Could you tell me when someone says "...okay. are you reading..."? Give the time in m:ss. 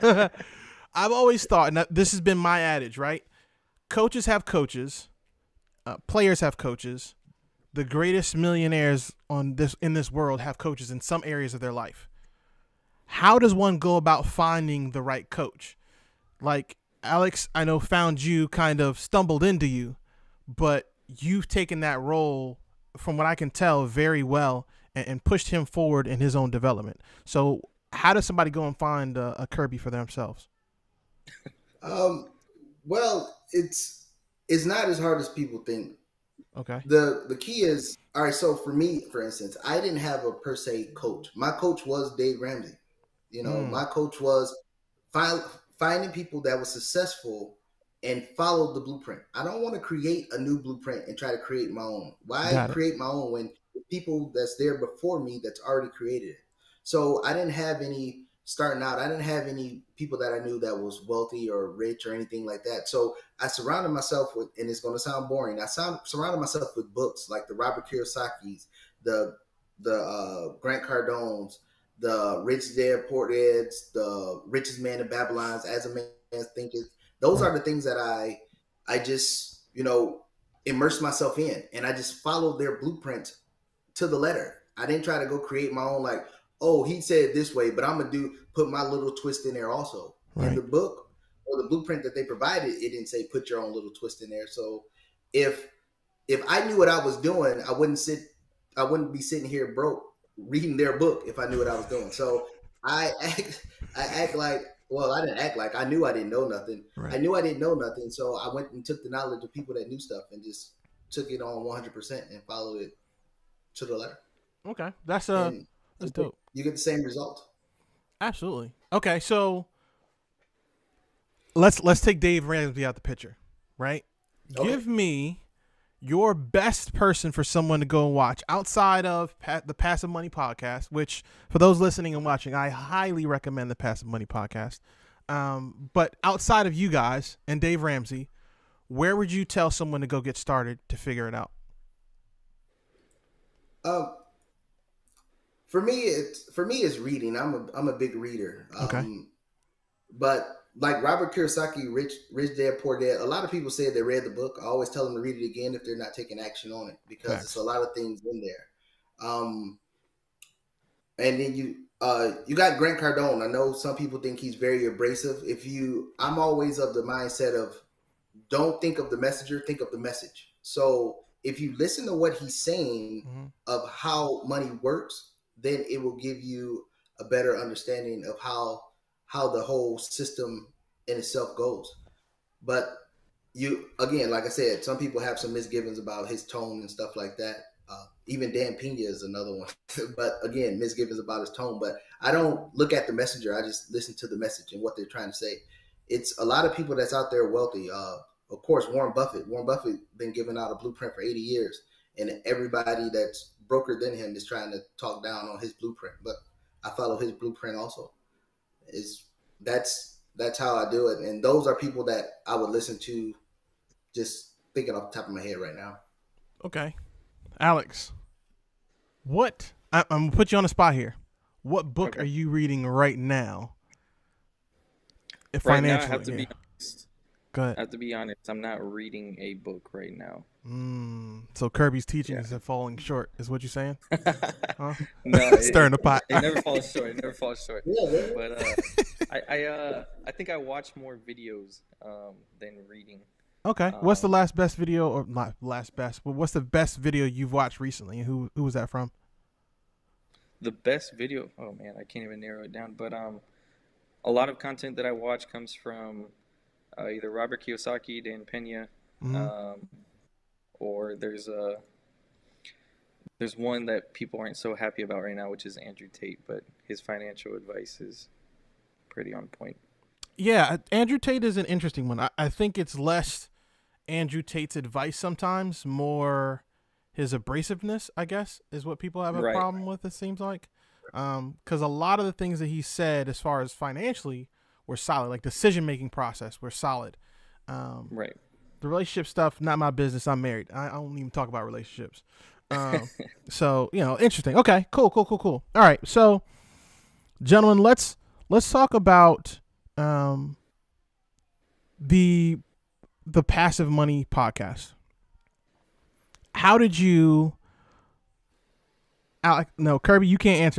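3:42.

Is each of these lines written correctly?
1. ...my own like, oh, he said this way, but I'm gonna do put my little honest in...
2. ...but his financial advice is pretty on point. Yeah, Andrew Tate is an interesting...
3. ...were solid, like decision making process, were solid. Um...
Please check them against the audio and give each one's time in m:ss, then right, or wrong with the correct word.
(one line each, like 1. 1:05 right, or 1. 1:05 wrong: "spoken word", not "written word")
1. 1:25 wrong: "twist", not "honest"
2. 4:26 right
3. 4:44 right.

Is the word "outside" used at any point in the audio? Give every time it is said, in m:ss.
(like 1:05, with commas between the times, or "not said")
2:08, 2:16.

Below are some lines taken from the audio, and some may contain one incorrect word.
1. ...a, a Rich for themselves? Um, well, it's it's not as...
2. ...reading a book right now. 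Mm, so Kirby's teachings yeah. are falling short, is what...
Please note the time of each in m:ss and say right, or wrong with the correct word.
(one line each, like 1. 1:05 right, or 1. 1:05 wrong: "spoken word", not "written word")
1. 0:29 wrong: "Kirby", not "Rich"
2. 3:48 right.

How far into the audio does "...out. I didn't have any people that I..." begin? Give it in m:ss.
0:58.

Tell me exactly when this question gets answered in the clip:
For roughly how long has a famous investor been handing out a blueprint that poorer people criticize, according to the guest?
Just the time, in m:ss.
3:21.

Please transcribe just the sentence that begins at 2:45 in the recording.
If you, I'm always of the mindset of don't think of the messenger, think of the message.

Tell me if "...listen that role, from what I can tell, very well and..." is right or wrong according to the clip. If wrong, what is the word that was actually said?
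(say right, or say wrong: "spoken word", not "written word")
wrong: "taken", not "listen".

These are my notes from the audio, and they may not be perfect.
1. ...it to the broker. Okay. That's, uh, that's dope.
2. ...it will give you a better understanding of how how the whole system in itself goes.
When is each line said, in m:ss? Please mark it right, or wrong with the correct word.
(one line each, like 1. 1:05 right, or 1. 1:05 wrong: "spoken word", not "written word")
1. 1:52 wrong: "letter", not "broker"
2. 2:55 right.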